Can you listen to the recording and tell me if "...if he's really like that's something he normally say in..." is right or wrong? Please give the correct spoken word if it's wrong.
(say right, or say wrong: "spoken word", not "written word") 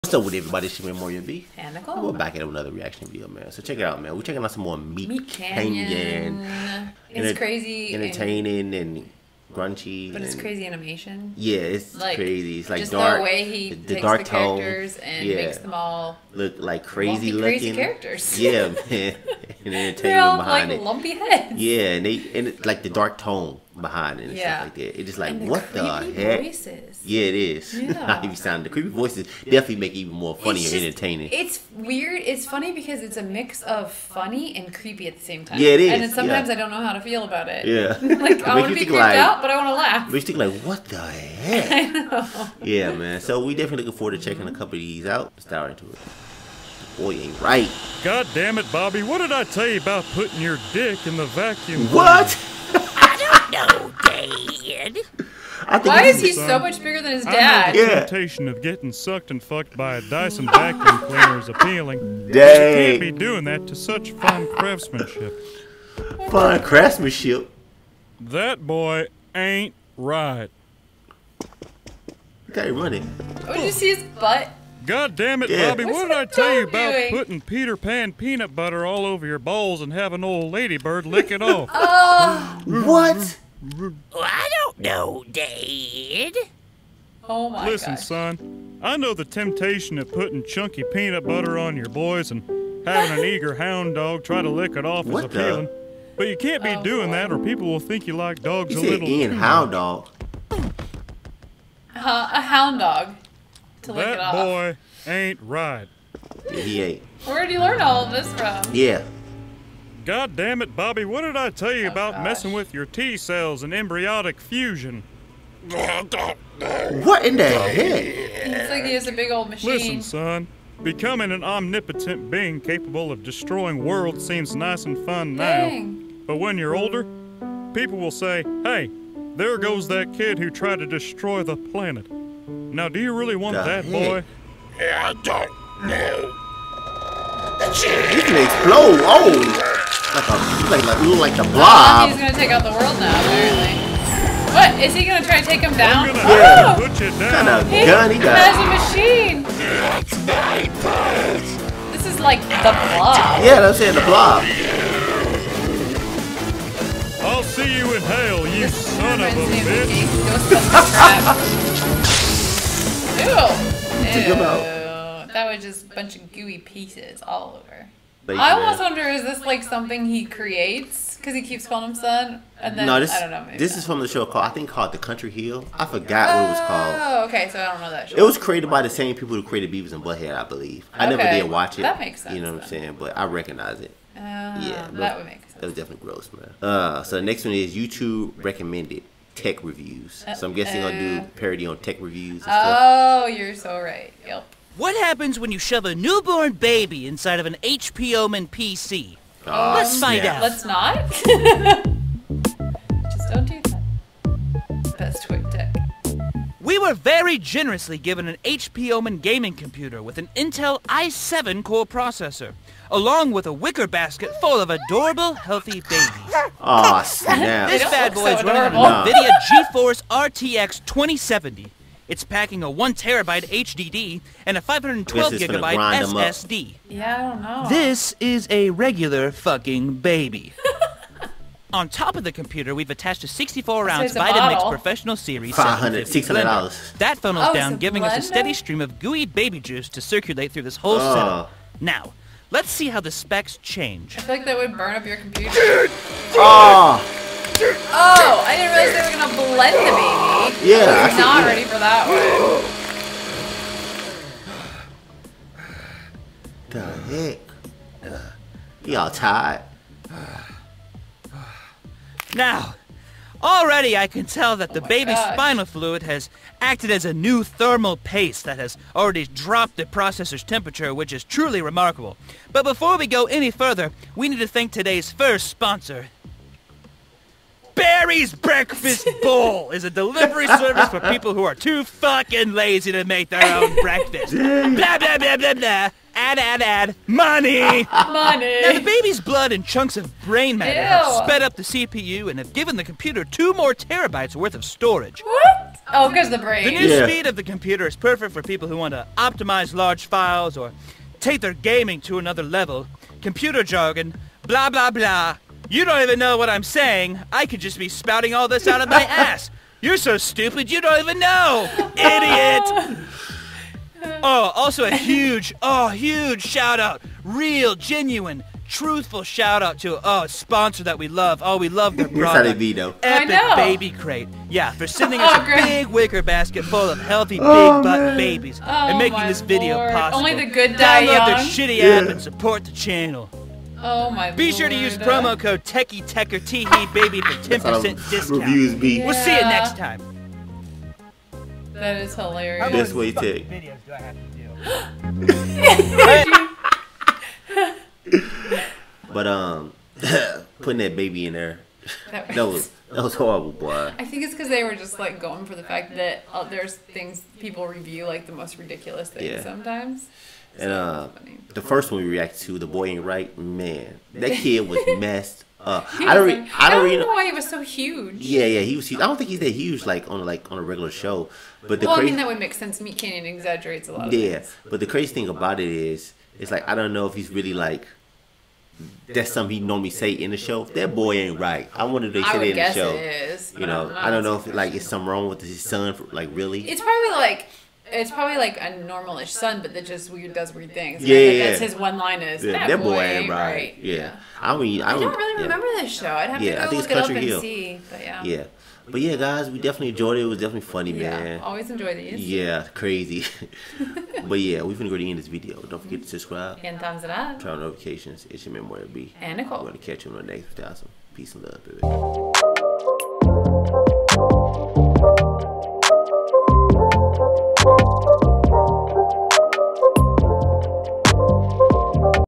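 right.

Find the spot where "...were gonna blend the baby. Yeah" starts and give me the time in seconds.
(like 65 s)
249 s.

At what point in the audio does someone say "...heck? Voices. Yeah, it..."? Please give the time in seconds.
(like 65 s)
26 s.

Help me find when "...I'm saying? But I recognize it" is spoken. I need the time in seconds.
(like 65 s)
182 s.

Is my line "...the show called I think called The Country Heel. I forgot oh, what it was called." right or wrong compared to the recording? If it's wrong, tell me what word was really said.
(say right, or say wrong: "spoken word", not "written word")
right.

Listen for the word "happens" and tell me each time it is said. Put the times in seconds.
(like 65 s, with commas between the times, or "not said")
195 s.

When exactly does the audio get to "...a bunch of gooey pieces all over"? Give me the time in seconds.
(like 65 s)
165 s.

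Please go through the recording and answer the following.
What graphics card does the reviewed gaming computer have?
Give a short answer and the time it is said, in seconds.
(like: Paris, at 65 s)
NVIDIA GeForce RTX 2070, at 219 s.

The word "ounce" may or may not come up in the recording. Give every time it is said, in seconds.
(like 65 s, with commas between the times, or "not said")
233 s.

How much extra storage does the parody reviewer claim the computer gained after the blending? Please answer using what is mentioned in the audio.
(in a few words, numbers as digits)
2 terabytes.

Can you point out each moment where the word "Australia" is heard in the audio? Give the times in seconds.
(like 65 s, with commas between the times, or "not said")
not said.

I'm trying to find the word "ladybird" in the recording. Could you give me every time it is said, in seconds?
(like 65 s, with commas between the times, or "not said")
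80 s.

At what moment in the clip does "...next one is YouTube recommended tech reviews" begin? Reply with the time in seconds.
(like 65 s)
187 s.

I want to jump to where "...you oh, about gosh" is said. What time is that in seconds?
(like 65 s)
111 s.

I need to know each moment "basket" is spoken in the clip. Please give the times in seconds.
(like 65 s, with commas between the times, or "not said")
213 s, 326 s.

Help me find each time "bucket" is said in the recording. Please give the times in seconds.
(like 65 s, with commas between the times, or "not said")
not said.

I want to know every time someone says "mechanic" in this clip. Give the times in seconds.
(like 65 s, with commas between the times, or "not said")
not said.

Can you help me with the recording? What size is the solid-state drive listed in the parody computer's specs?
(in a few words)
512 gigabyte.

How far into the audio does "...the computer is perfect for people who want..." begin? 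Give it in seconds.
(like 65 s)
297 s.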